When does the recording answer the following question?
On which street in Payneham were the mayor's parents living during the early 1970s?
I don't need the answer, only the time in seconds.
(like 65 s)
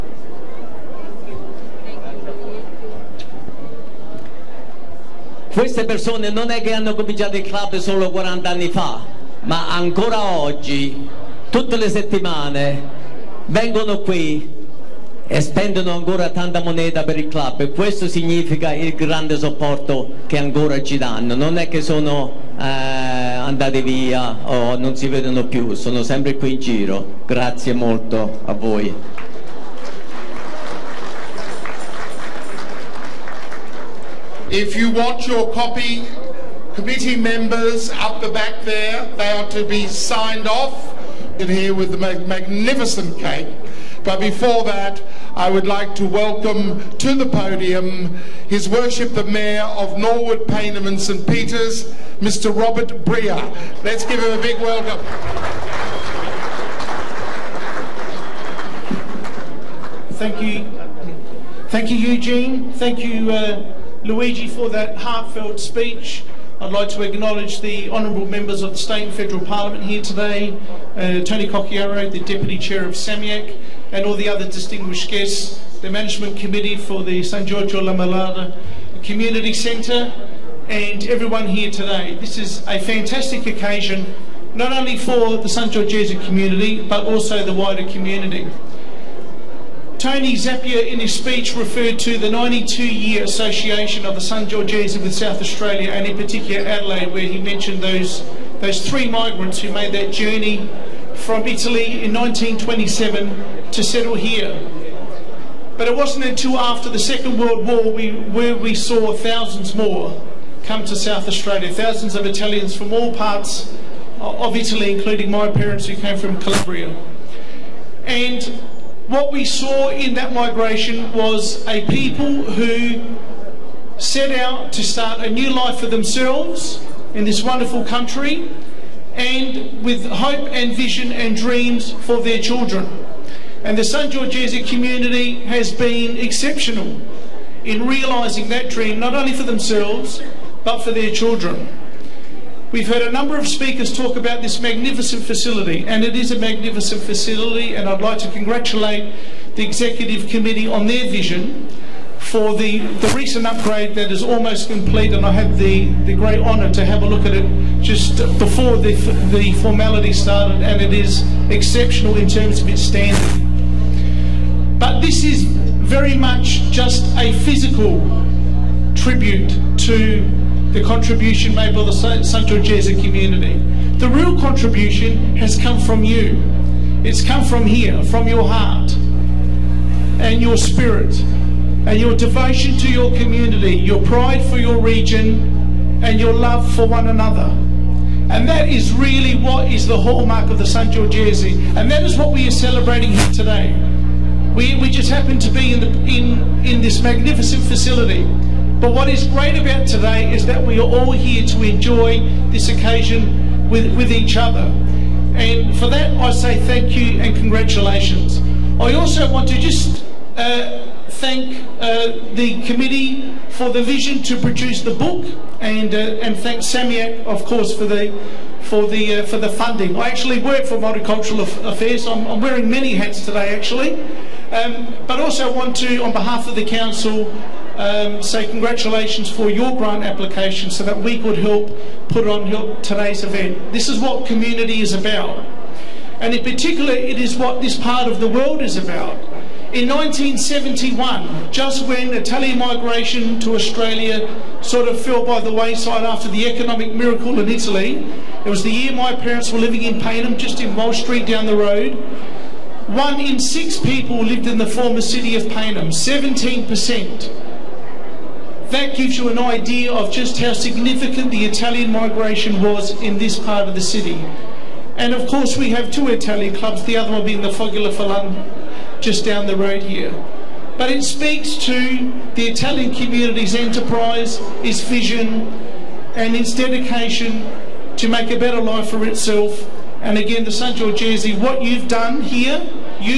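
250 s.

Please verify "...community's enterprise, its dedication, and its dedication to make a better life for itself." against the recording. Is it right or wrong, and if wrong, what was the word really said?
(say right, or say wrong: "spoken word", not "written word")
wrong: "vision", not "dedication".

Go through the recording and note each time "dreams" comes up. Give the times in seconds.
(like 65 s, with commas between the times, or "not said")
131 s, 138 s.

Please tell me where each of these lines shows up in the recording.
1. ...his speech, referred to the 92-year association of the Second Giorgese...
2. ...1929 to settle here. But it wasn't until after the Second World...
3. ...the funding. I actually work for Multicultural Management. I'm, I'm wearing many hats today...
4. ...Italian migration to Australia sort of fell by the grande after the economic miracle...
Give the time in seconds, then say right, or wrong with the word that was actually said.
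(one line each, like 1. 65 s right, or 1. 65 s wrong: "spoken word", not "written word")
1. 90 s wrong: "San", not "Second"
2. 102 s wrong: "1927", not "1929"
3. 219 s wrong: "Affairs", not "Management"
4. 242 s wrong: "wayside", not "grande".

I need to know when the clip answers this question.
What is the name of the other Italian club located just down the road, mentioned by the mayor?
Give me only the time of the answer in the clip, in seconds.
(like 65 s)
267 s.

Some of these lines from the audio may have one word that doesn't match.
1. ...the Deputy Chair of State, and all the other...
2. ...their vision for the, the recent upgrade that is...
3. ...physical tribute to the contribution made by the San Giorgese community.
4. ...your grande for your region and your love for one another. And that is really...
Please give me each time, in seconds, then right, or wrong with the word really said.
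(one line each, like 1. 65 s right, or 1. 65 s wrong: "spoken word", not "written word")
1. 72 s wrong: "SAMEAC", not "State"
2. 150 s right
3. 167 s right
4. 183 s wrong: "pride", not "grande".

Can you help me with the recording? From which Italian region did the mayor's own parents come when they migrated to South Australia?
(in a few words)
Calabria.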